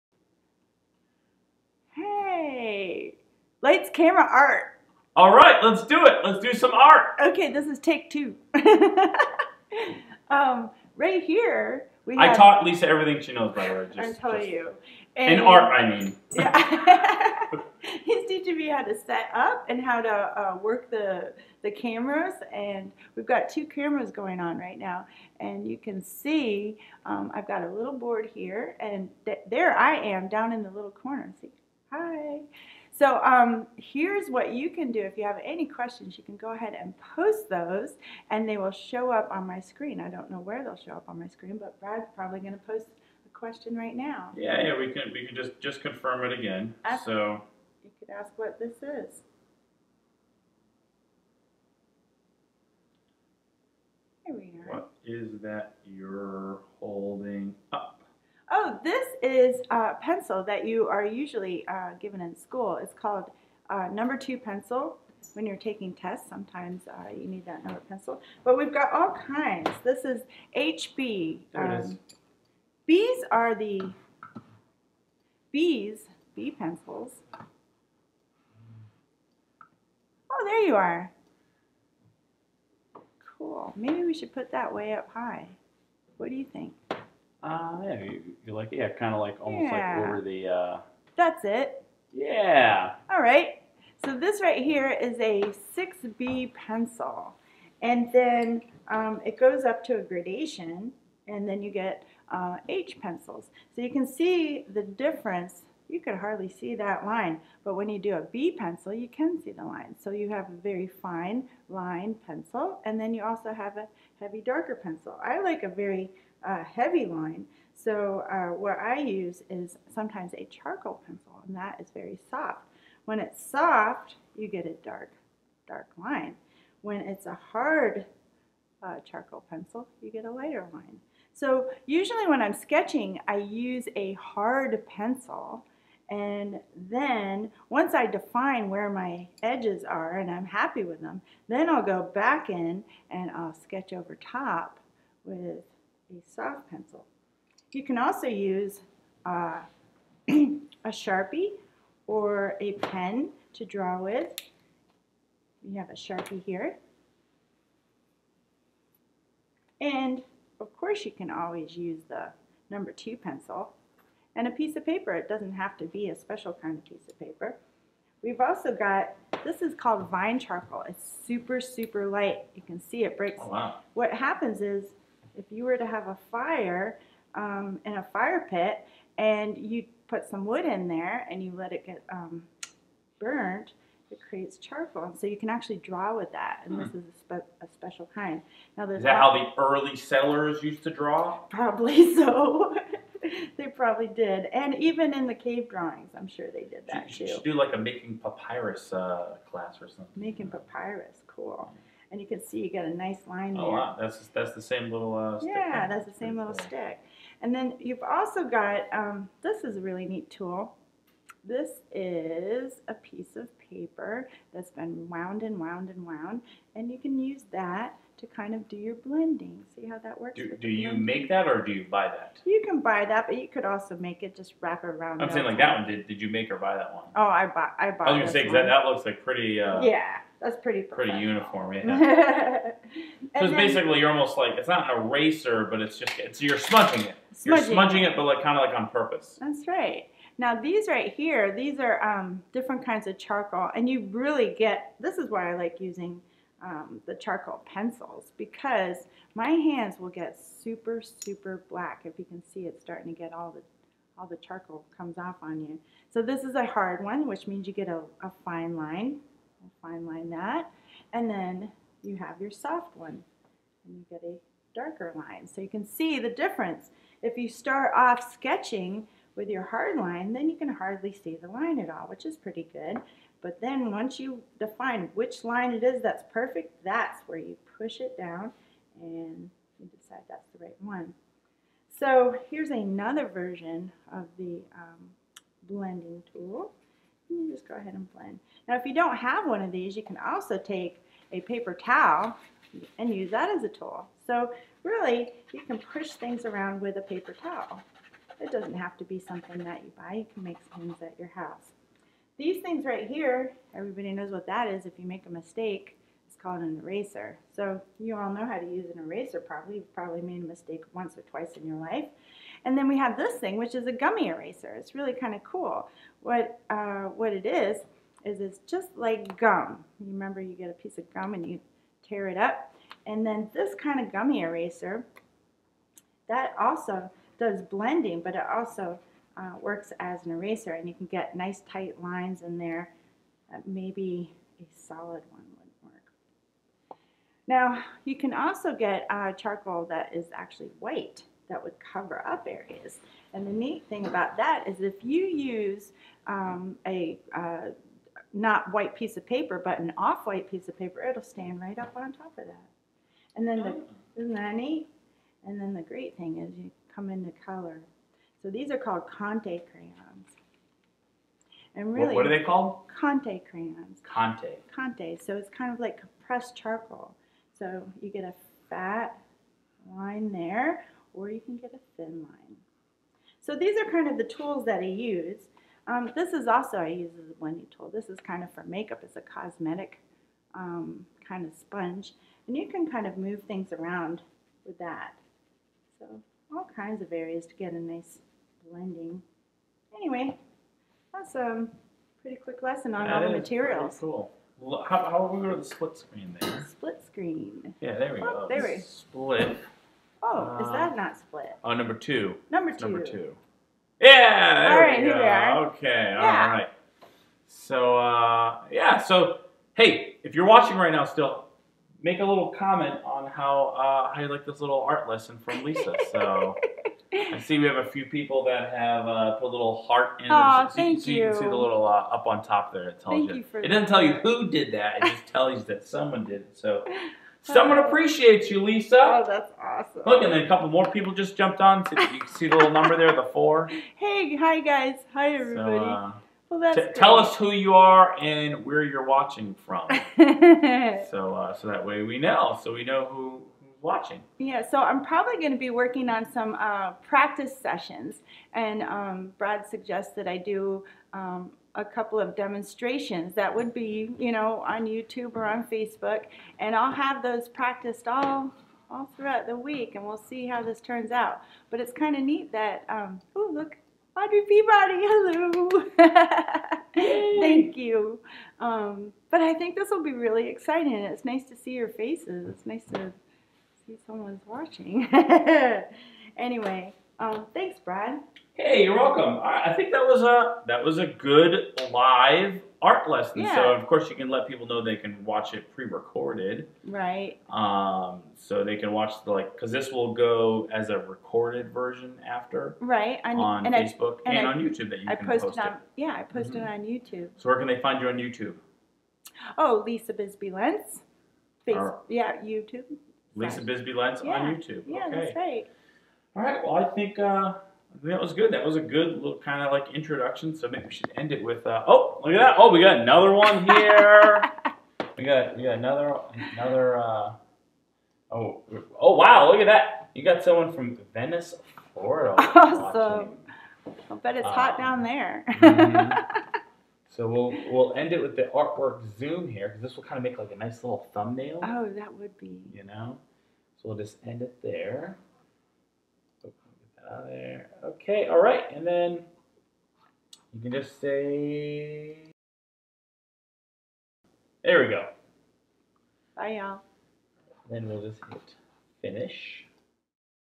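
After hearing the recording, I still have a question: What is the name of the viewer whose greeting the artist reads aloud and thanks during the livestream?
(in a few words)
Audrey Peabody.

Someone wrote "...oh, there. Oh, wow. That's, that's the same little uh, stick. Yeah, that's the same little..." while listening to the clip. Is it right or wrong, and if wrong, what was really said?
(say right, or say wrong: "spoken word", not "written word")
right.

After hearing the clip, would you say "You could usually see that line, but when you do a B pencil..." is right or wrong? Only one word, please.
wrong.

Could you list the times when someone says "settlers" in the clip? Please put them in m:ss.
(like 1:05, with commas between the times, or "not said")
3:09.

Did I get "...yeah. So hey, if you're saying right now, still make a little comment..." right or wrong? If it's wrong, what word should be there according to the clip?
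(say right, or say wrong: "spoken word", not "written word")
wrong: "watching", not "saying".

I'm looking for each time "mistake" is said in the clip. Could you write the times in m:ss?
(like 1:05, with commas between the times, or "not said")
5:05, 5:10.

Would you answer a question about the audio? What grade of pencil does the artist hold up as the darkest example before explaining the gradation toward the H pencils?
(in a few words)
6B.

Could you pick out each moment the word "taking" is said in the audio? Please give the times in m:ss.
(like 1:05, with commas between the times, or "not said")
1:05.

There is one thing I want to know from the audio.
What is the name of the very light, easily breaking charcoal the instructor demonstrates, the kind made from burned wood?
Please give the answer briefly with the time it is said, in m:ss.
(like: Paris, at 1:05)
vine charcoal, at 2:50.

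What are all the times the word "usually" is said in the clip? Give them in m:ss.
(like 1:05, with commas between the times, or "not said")
1:01, 2:11.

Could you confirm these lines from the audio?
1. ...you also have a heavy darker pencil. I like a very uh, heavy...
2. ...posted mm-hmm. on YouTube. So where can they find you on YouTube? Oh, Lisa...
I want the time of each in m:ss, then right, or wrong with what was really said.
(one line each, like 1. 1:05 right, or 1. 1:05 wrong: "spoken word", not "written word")
1. 1:53 right
2. 8:16 right.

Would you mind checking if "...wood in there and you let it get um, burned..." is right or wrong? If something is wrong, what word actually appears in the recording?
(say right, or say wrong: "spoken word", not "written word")
right.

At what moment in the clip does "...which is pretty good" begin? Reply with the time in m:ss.
4:32.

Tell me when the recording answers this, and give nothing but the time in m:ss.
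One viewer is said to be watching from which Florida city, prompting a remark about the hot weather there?
8:41.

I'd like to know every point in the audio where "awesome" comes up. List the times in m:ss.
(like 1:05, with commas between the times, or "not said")
7:09, 8:42.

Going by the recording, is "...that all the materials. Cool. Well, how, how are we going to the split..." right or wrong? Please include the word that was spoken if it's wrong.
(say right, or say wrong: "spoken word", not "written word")
right.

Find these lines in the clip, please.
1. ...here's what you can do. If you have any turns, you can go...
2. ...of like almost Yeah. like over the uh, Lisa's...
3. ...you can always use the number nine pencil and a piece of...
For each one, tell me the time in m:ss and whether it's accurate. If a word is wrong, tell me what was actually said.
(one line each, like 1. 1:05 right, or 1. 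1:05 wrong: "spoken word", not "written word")
1. 0:33 wrong: "questions", not "turns"
2. 1:29 wrong: "That", not "Lisa"
3. 2:41 wrong: "two", not "nine".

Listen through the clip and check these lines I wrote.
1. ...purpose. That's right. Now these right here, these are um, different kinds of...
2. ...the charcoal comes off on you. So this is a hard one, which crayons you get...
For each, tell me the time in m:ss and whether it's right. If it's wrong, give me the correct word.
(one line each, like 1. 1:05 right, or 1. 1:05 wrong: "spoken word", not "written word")
1. 3:58 right
2. 4:14 wrong: "means", not "crayons".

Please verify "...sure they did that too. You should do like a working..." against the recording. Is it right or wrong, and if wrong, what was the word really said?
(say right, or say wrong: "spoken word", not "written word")
wrong: "making", not "working".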